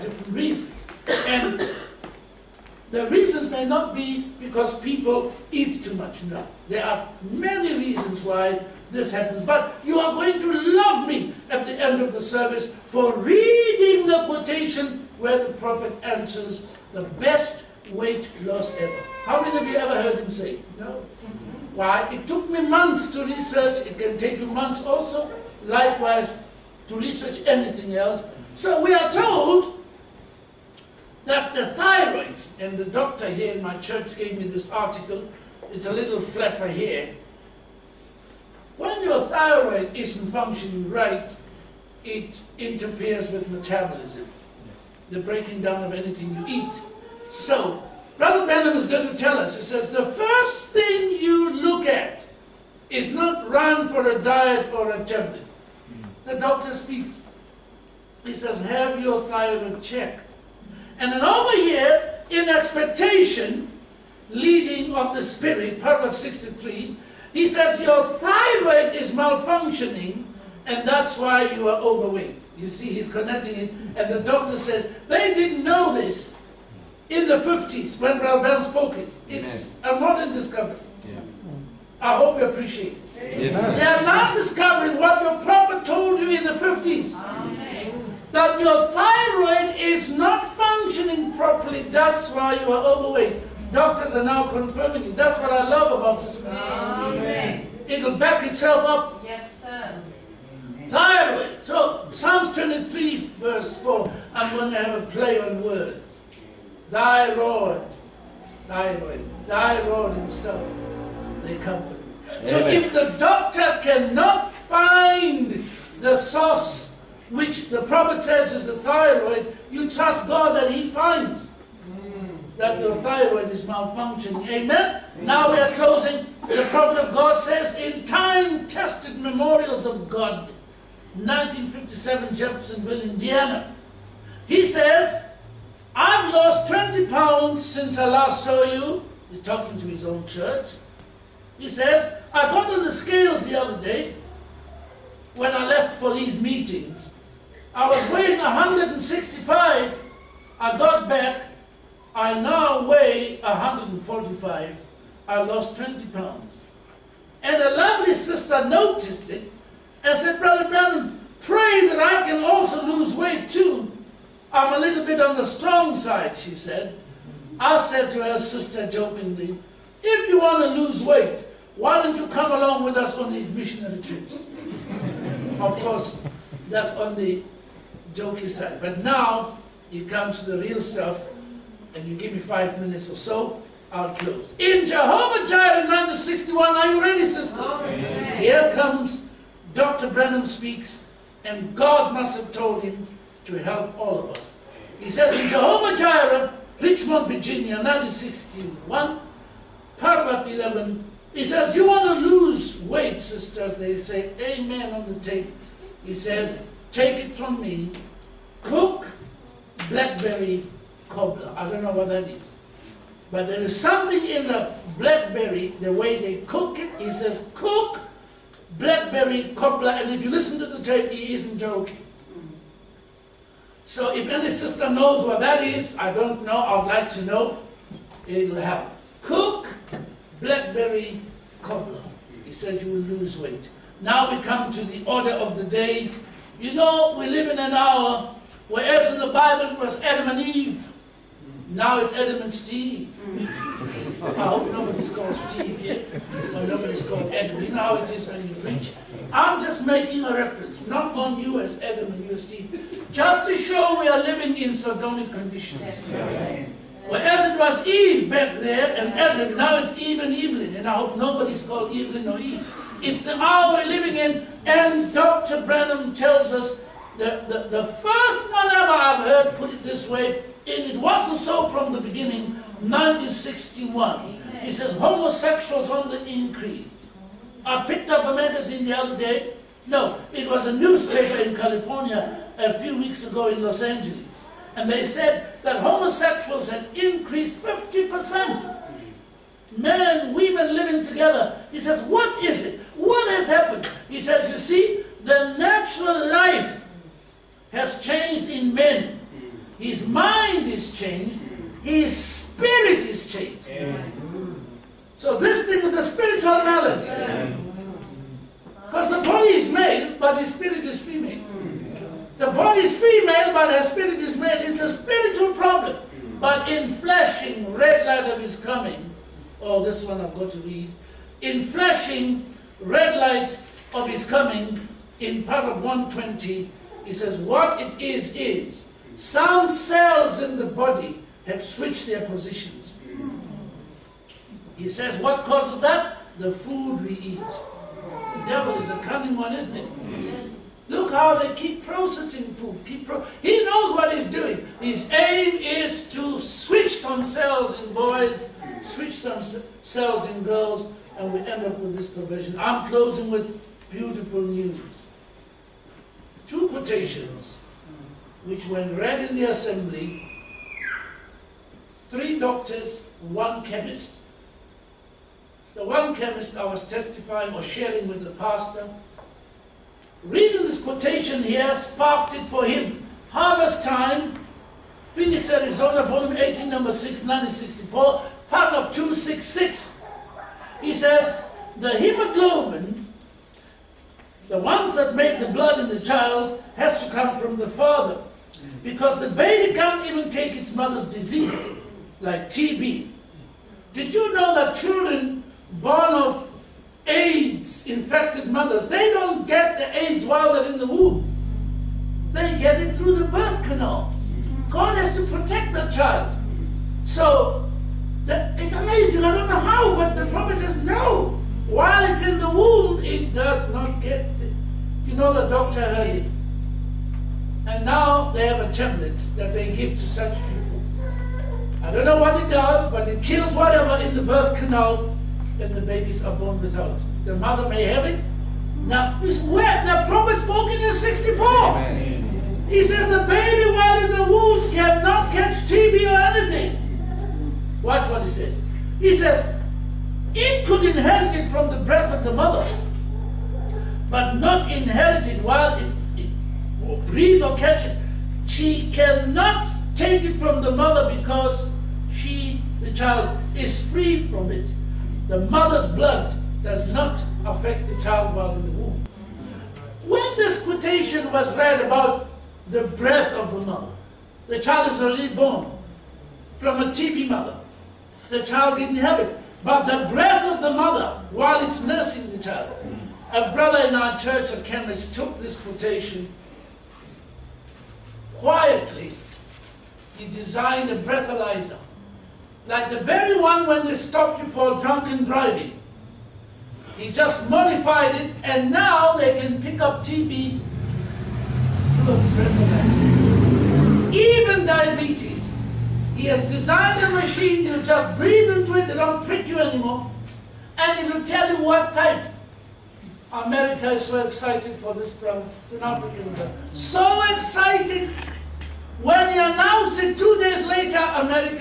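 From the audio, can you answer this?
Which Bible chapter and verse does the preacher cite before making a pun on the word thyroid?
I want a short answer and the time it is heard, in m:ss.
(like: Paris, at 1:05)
Psalms 23:4, at 1:42.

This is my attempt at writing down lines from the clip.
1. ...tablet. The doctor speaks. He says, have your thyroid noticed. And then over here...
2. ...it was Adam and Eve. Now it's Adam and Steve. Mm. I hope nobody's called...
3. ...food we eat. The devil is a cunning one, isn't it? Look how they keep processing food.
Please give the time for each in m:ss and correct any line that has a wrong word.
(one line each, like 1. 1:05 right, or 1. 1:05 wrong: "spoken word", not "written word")
1. 0:55 wrong: "checked", not "noticed"
2. 3:59 right
3. 5:36 right.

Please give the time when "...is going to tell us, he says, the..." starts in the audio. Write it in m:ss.
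0:48.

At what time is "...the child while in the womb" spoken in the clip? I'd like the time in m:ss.
7:37.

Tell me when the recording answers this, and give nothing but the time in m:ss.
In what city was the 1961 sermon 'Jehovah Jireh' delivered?
3:16.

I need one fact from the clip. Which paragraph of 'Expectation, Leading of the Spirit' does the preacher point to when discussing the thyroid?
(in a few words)
63.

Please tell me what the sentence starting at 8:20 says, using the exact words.
And it'll tell you what type.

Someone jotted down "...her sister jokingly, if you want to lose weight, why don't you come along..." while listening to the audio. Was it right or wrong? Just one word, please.
right.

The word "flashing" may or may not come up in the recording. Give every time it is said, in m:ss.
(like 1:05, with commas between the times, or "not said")
5:16, 5:21.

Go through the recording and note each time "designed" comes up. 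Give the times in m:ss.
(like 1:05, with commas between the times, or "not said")
8:00, 8:16.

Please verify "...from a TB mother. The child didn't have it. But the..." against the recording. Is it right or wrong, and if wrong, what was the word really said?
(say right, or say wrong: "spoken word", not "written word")
right.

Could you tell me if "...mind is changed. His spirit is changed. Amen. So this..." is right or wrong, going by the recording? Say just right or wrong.
right.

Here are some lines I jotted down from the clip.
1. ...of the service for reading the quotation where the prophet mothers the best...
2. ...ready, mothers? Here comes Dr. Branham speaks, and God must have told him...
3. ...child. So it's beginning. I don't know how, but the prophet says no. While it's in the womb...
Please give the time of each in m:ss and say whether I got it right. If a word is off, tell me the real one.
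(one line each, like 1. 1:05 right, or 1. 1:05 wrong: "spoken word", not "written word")
1. 0:12 wrong: "answers", not "mothers"
2. 3:07 wrong: "sisters", not "mothers"
3. 6:45 wrong: "amazing", not "beginning".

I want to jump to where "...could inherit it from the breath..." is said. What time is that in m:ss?
7:20.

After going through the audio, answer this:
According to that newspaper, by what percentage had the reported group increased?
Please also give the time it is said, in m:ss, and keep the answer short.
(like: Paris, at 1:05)
50%, at 4:47.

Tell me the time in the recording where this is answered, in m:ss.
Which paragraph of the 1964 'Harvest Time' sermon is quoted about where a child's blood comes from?
6:18.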